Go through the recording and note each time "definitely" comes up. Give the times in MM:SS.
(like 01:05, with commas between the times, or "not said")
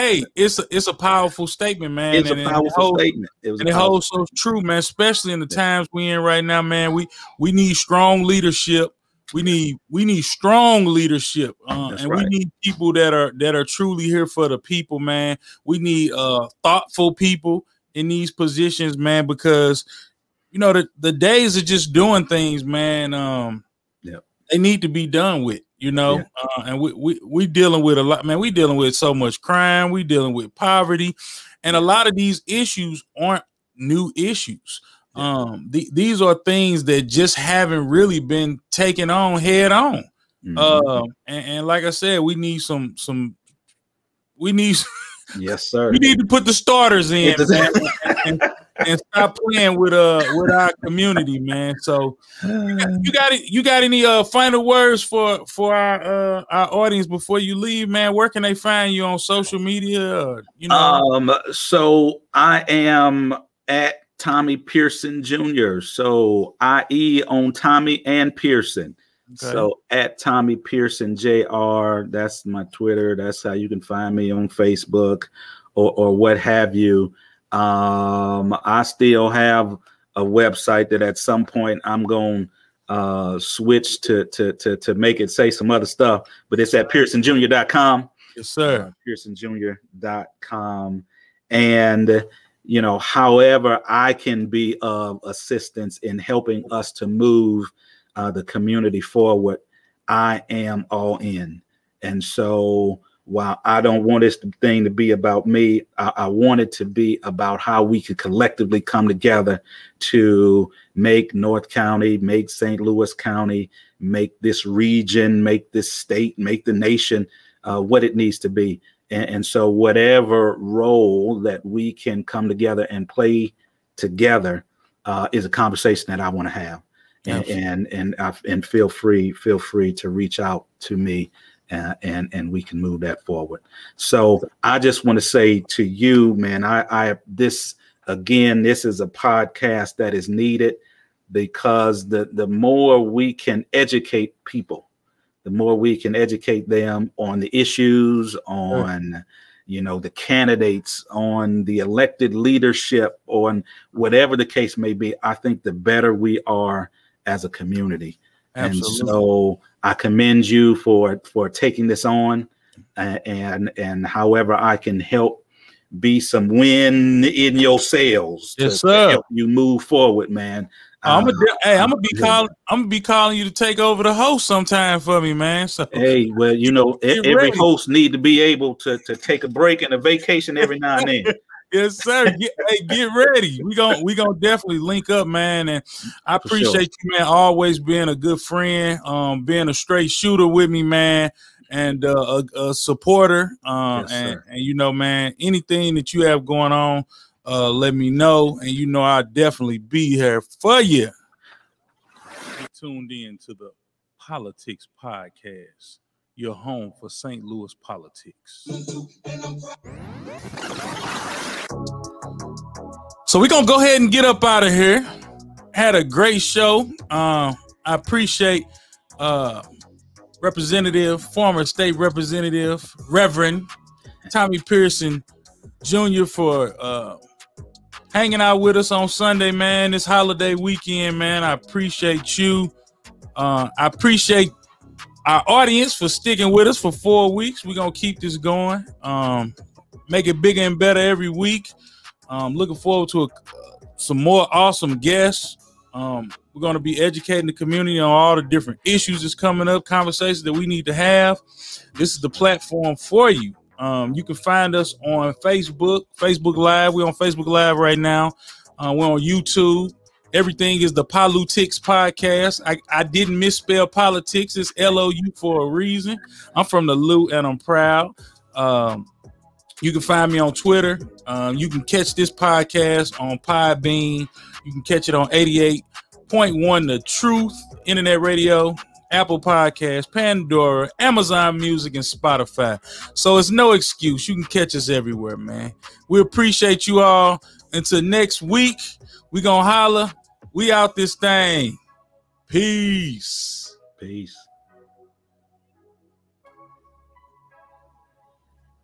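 03:04, 03:19.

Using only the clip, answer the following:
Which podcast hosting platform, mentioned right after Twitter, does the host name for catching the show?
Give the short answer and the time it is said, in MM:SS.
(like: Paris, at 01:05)
Podbean, at 04:33.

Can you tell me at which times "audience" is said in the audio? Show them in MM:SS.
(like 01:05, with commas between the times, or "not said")
00:56, 03:55.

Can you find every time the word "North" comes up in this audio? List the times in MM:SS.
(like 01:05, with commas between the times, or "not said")
01:51.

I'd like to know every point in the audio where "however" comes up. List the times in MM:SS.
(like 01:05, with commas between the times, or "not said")
01:32, 02:44.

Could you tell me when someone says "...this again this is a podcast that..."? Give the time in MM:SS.
02:17.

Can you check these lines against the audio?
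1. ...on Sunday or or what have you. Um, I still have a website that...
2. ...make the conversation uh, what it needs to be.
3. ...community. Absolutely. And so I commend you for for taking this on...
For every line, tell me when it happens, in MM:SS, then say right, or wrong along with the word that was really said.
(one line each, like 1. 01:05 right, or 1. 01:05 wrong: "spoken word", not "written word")
1. 01:14 wrong: "Facebook", not "Sunday"
2. 01:56 wrong: "nation", not "conversation"
3. 02:37 right.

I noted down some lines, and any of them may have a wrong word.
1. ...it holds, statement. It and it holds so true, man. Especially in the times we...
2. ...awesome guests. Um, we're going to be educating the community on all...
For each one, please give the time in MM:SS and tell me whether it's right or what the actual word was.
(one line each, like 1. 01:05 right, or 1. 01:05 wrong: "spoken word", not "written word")
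1. 00:02 right
2. 04:04 right.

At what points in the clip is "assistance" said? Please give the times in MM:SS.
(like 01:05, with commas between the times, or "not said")
01:35.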